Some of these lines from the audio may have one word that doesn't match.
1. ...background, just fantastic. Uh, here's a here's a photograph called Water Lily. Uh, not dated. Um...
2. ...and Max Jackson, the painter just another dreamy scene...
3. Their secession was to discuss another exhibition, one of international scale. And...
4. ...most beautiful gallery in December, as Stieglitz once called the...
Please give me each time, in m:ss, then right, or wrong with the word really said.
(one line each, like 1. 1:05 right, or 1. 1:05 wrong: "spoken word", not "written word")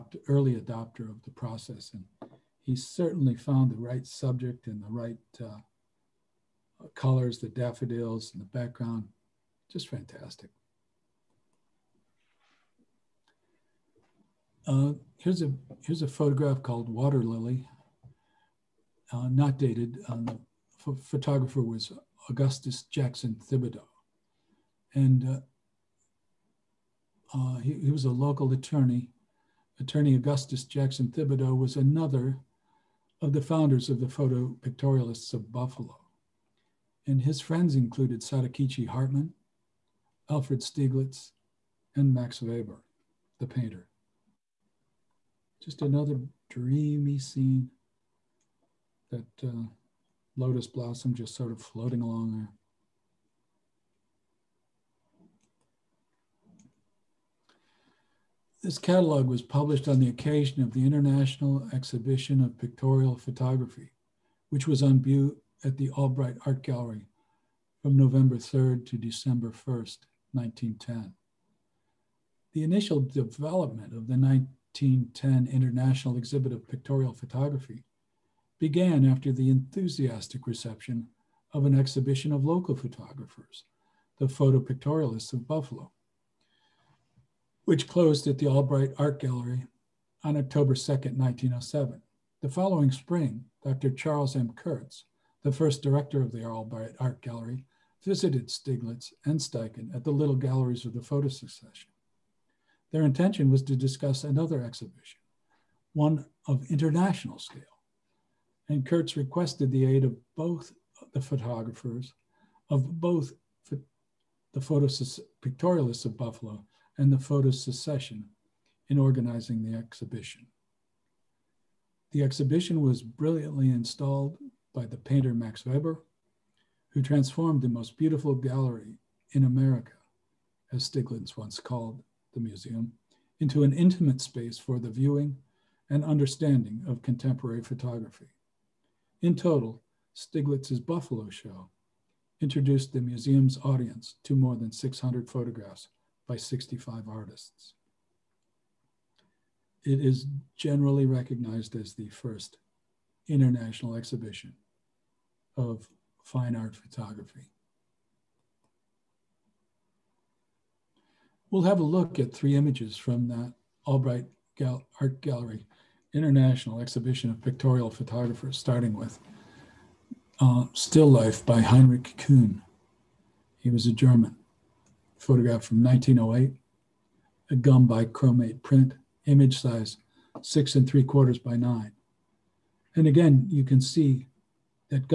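1. 0:08 right
2. 0:41 wrong: "Weber", not "Jackson"
3. 1:42 wrong: "intention", not "secession"
4. 2:07 wrong: "America", not "December".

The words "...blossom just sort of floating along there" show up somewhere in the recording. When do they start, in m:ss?
0:50.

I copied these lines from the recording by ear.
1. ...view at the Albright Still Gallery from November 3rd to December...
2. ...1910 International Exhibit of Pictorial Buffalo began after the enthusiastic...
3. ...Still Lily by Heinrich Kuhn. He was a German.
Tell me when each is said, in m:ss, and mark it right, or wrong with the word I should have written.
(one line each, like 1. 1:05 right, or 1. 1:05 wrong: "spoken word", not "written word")
1. 1:05 wrong: "Art", not "Still"
2. 1:14 wrong: "Photography", not "Buffalo"
3. 2:50 wrong: "Life", not "Lily".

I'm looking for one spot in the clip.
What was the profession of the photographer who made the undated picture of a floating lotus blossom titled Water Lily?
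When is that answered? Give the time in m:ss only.
0:28.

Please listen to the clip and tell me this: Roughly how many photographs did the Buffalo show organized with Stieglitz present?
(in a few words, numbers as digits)
More than 600.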